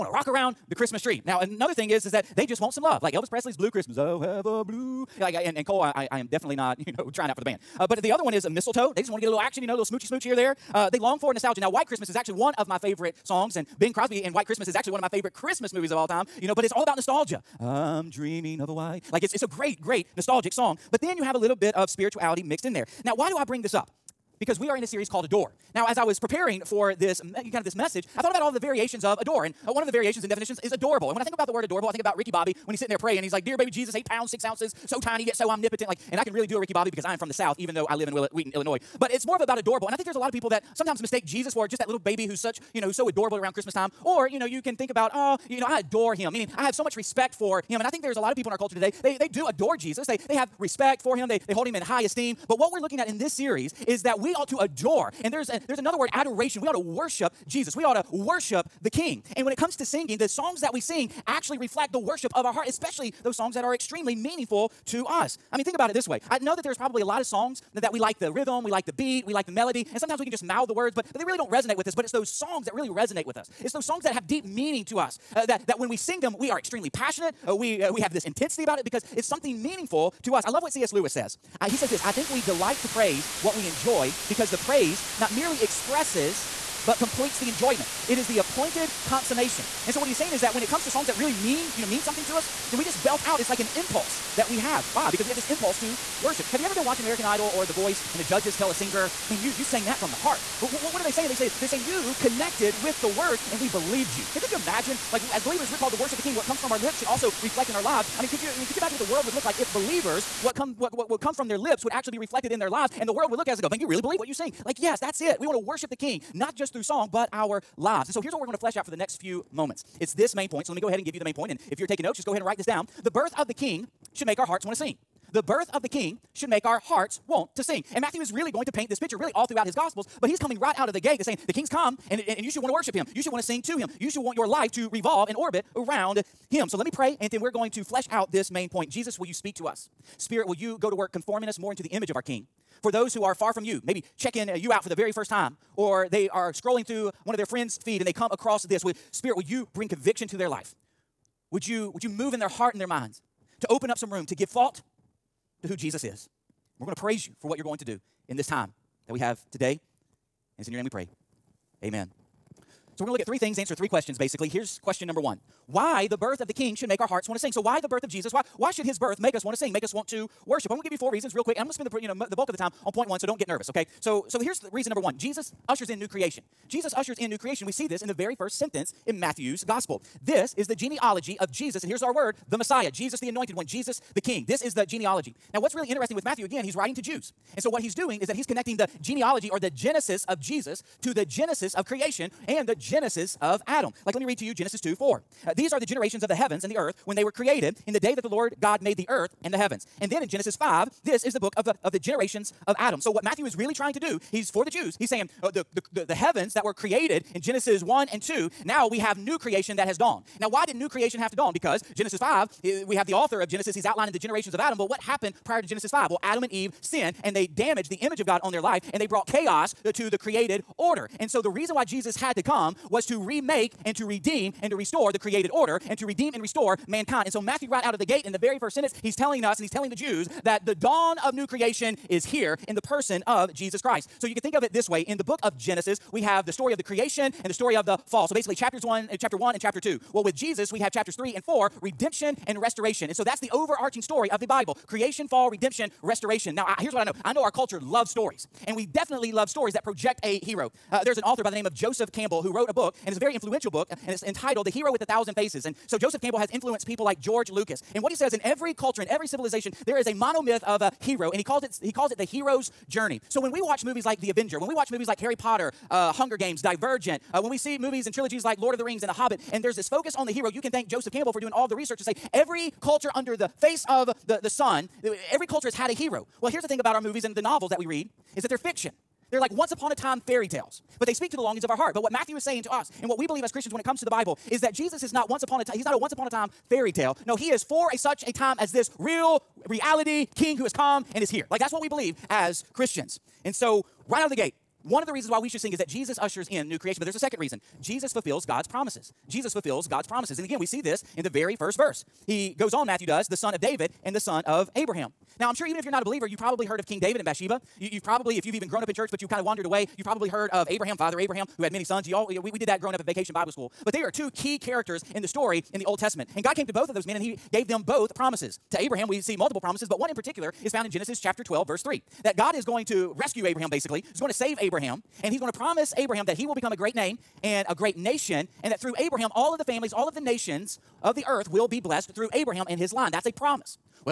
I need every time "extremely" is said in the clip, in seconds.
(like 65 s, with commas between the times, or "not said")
63 s, 76 s.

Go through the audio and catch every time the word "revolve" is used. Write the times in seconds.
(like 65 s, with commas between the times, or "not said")
134 s.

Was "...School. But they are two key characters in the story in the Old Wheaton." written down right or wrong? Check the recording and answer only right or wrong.
wrong.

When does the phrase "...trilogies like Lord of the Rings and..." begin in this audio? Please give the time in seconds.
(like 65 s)
268 s.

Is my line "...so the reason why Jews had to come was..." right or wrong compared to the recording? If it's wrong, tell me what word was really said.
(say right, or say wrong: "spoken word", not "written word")
wrong: "Jesus", not "Jews".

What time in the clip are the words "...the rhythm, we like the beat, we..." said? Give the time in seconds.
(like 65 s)
68 s.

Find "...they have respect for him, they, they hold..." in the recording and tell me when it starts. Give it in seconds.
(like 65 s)
50 s.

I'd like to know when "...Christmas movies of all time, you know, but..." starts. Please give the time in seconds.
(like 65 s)
15 s.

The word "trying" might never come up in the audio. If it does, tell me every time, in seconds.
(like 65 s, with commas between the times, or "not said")
7 s, 203 s.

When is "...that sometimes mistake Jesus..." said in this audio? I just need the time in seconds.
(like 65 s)
40 s.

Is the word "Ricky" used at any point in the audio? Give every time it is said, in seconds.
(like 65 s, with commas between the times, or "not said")
32 s, 36 s.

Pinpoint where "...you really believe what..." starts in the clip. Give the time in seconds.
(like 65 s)
113 s.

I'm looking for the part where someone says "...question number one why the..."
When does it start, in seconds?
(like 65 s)
164 s.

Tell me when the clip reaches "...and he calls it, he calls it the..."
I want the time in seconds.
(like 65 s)
261 s.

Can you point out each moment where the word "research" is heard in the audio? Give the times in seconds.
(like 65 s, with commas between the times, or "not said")
271 s.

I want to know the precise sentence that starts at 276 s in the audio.
Well, here's the thing about our movies and the novels that we read is that they're fiction.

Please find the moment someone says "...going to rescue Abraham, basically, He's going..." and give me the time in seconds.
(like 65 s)
322 s.